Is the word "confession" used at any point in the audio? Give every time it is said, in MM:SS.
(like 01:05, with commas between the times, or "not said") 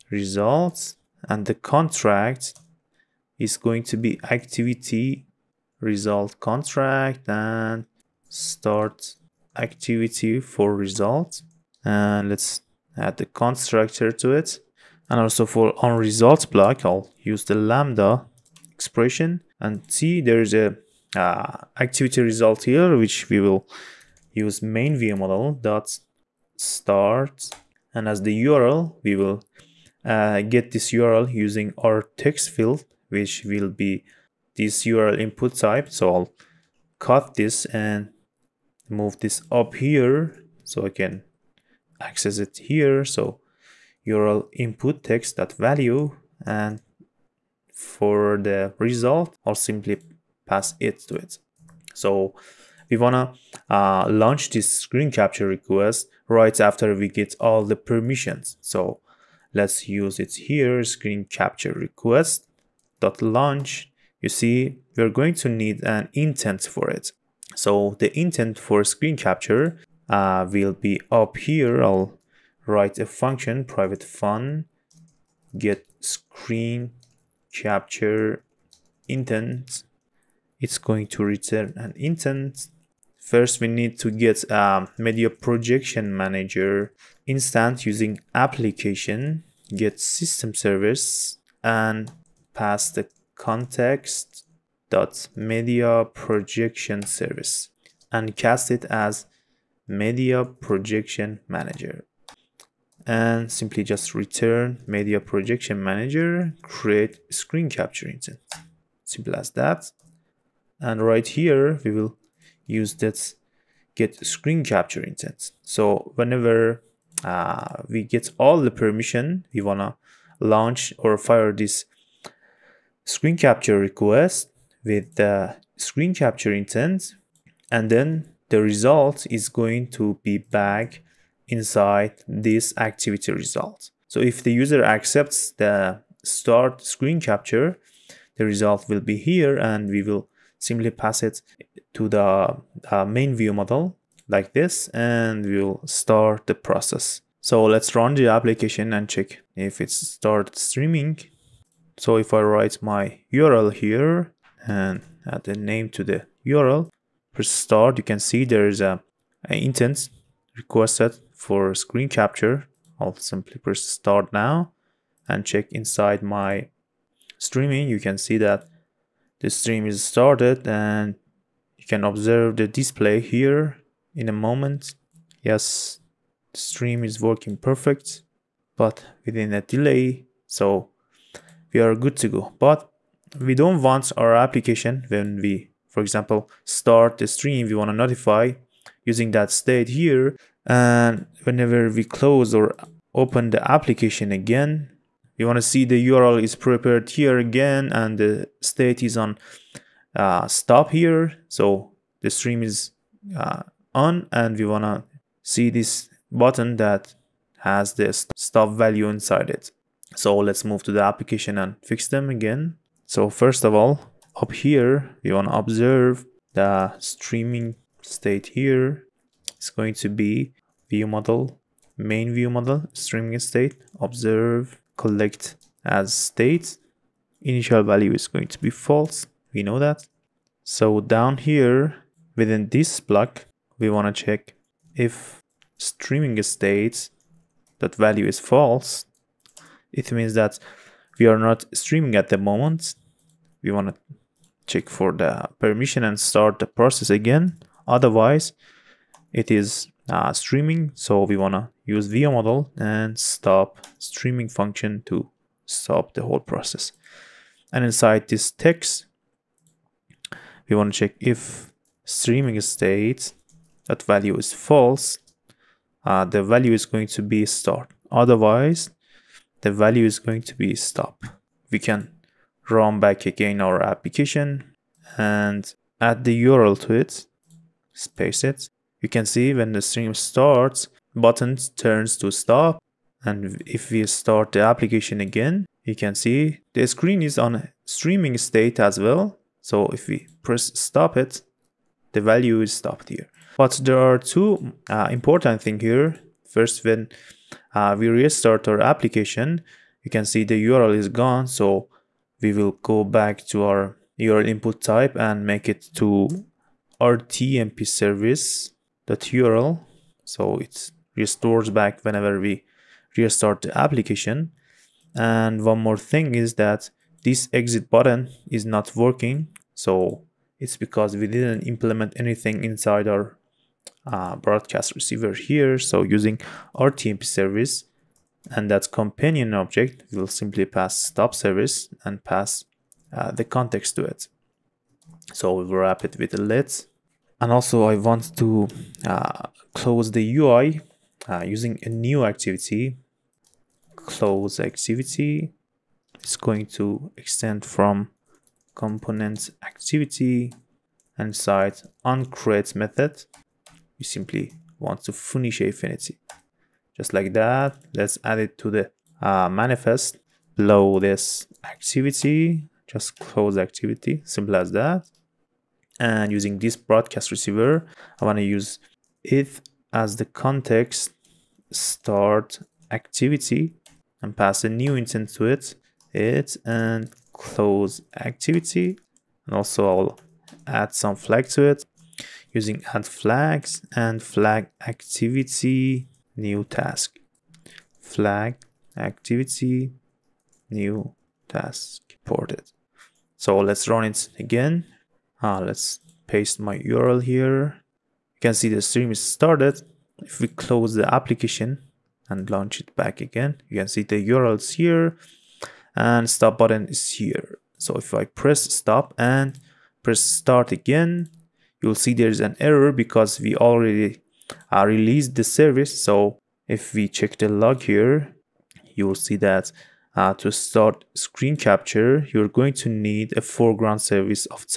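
not said.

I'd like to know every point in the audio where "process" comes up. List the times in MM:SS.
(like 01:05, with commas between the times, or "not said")
02:26, 04:06, 04:16.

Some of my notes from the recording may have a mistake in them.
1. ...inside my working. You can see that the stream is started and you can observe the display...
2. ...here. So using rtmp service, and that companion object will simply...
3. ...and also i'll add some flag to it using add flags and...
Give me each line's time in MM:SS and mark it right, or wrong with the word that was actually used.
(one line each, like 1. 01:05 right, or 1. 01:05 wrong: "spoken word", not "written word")
1. 02:45 wrong: "streaming", not "working"
2. 05:25 right
3. 06:19 right.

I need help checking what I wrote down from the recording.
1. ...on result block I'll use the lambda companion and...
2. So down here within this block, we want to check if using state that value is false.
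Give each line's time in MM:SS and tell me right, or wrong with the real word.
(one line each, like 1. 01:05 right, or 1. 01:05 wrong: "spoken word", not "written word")
1. 00:15 wrong: "expression", not "companion"
2. 03:50 wrong: "streaming", not "using".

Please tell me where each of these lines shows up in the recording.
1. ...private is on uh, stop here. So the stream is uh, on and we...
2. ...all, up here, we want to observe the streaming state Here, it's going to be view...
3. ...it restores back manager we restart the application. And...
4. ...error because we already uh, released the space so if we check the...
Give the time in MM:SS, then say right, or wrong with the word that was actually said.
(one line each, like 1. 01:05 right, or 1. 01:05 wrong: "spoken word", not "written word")
1. 03:18 wrong: "state", not "private"
2. 03:33 right
3. 05:10 wrong: "whenever", not "manager"
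4. 06:52 wrong: "service", not "space".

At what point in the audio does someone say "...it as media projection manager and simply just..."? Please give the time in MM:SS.
01:38.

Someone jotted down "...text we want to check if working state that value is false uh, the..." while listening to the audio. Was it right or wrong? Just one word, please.
wrong.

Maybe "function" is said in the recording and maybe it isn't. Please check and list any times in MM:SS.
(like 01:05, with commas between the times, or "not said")
01:13, 04:14.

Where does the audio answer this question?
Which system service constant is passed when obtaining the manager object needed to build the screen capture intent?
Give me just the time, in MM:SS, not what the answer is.
01:35.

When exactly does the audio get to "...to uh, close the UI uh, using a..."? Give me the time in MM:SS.
05:38.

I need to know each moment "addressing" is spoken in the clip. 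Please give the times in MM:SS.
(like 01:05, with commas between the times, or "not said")
not said.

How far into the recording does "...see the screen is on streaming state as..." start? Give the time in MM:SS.
04:46.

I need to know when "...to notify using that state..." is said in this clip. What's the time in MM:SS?
03:07.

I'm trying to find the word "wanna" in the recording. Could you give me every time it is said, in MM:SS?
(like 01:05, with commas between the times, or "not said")
00:52, 01:59.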